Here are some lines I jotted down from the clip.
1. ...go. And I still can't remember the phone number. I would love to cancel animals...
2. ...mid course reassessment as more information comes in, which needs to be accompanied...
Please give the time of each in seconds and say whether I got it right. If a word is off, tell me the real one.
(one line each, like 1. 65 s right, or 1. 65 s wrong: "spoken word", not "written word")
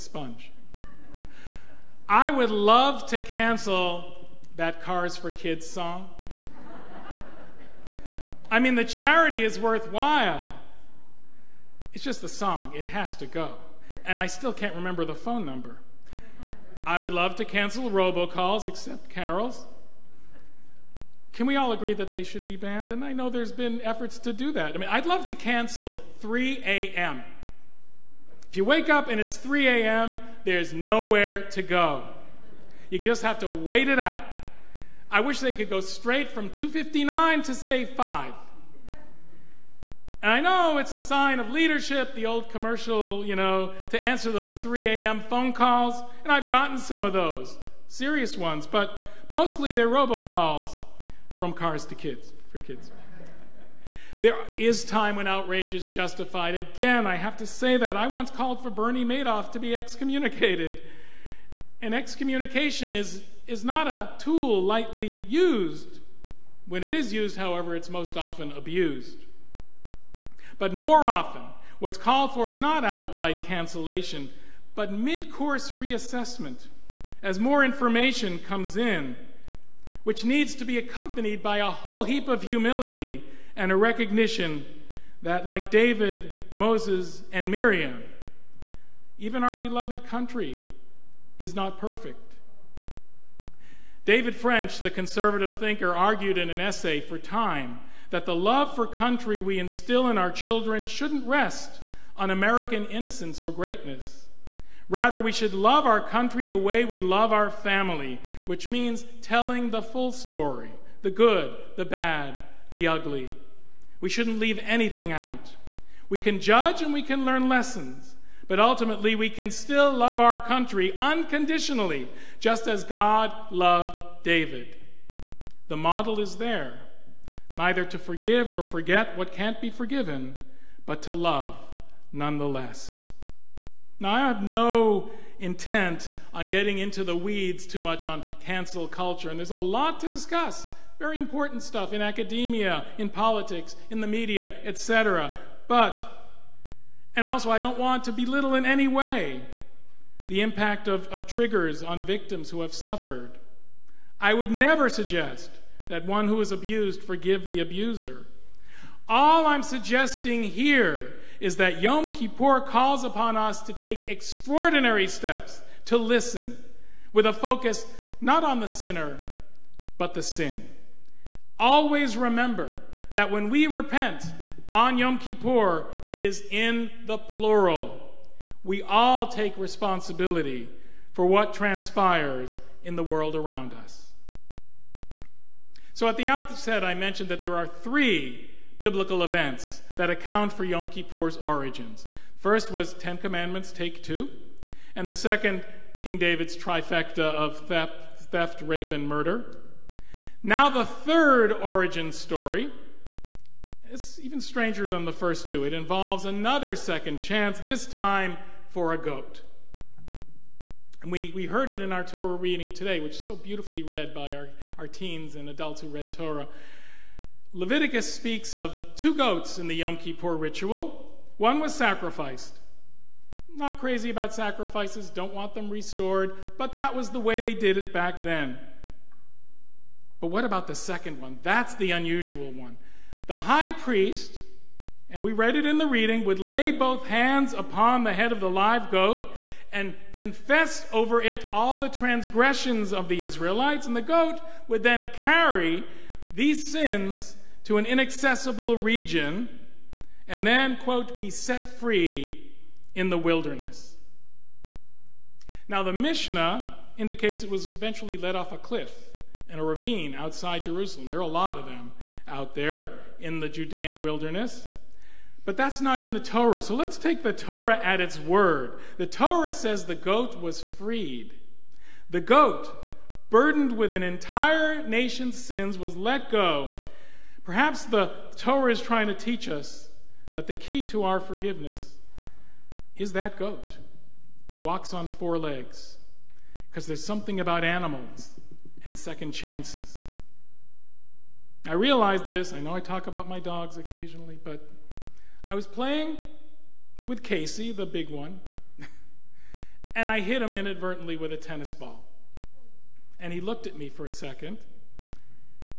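1. 13 s wrong: "robocalls", not "animals"
2. 74 s right.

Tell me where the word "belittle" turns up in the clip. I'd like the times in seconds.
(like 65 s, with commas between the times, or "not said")
148 s.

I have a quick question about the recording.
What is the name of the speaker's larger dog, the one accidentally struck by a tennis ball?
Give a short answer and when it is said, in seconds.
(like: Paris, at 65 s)
Casey, at 297 s.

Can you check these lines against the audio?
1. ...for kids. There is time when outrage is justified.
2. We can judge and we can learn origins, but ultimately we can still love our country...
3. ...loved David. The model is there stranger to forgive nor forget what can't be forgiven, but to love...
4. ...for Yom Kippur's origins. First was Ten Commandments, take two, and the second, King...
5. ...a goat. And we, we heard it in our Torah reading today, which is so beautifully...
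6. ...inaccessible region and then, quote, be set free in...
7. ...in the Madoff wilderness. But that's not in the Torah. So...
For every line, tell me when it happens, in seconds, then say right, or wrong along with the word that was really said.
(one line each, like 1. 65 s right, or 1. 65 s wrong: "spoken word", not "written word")
1. 52 s right
2. 116 s wrong: "lessons", not "origins"
3. 123 s wrong: "neither", not "stranger"
4. 190 s right
5. 208 s right
6. 247 s right
7. 263 s wrong: "Judean", not "Madoff".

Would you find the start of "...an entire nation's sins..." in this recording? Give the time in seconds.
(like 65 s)
273 s.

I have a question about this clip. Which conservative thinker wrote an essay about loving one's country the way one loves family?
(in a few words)
David French.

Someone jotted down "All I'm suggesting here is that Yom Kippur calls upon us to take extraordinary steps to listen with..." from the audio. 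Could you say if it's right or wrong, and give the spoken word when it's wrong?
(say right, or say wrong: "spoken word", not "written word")
right.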